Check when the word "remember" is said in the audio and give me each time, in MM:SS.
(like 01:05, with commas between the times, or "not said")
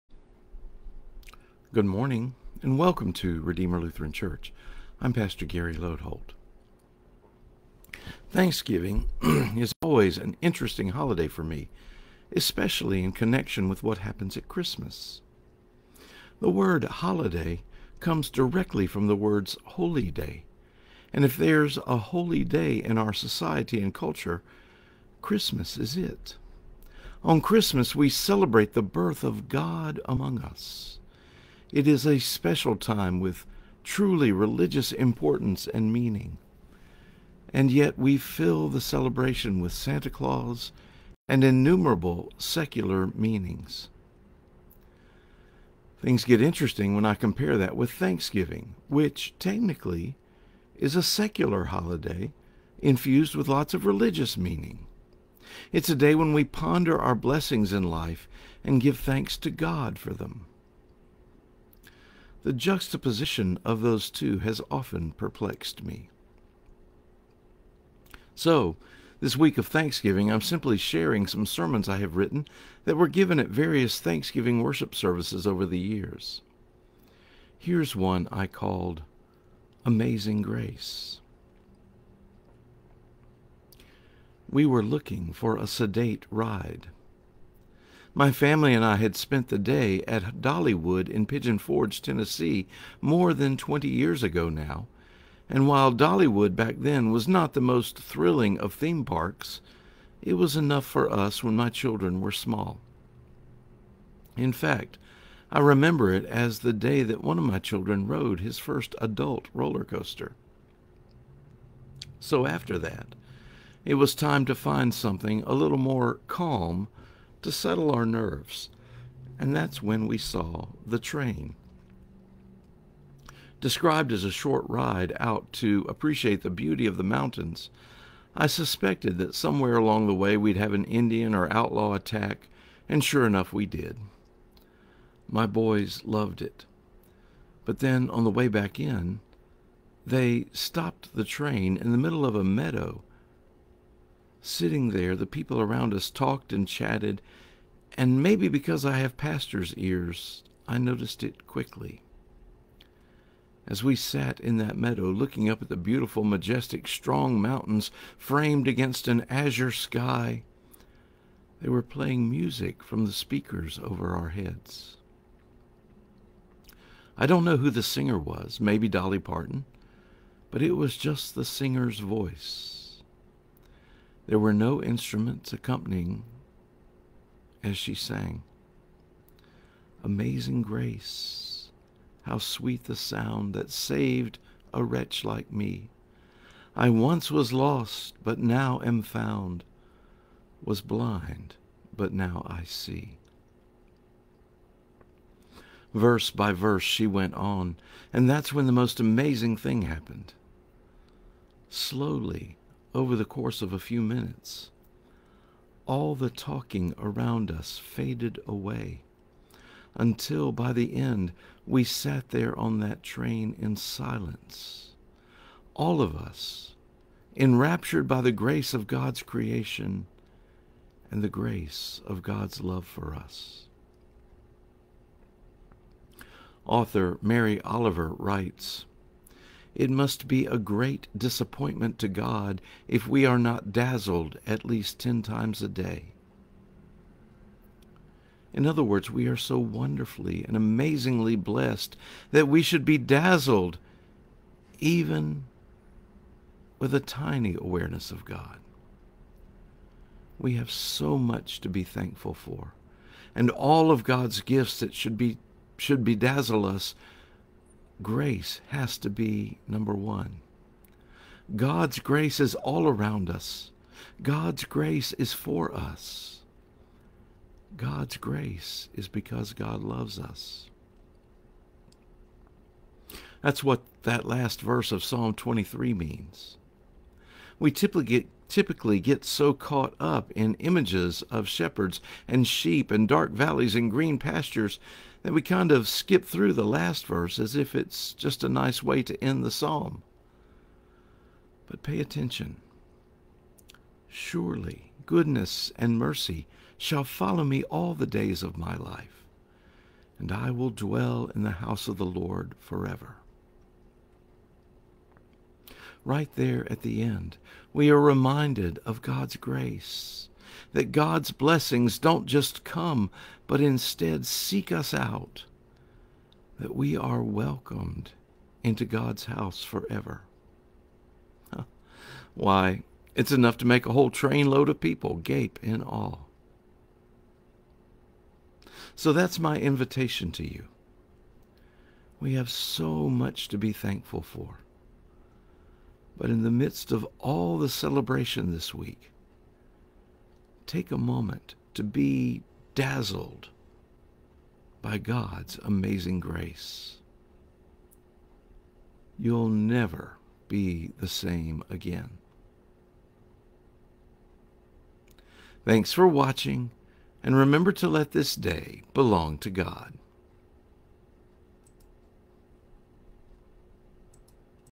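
01:45, 05:57.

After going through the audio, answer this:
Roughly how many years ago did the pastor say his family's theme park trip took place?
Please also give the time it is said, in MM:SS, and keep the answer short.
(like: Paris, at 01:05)
More than 20, at 01:32.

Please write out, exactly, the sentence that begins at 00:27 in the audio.
On Christmas, we celebrate the birth of God among us.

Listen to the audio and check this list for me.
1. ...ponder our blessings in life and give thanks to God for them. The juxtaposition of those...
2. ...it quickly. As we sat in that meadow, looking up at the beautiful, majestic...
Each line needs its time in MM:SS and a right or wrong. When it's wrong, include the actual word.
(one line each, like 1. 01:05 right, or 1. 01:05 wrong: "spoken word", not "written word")
1. 00:56 right
2. 02:31 right.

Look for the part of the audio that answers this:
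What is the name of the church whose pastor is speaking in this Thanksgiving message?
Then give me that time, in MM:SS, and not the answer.
00:03.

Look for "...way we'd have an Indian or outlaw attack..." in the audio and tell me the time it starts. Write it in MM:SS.
02:10.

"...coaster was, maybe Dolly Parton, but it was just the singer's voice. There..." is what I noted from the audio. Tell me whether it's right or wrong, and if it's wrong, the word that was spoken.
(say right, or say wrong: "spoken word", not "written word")
wrong: "singer", not "coaster".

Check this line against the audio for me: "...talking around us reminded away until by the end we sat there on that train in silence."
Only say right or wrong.
wrong.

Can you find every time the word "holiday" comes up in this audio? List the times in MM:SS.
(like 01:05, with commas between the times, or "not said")
00:10, 00:16, 00:51.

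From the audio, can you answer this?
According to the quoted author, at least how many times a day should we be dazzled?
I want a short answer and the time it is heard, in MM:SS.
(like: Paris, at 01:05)
10, at 03:54.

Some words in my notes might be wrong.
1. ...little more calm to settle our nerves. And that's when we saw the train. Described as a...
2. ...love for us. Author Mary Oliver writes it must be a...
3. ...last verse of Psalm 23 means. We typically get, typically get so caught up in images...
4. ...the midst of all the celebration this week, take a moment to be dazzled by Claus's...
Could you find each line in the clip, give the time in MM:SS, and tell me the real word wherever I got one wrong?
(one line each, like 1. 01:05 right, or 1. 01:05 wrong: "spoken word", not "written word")
1. 01:55 right
2. 03:42 right
3. 04:34 right
4. 05:36 wrong: "God", not "Claus".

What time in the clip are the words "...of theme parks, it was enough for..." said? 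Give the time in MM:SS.
01:38.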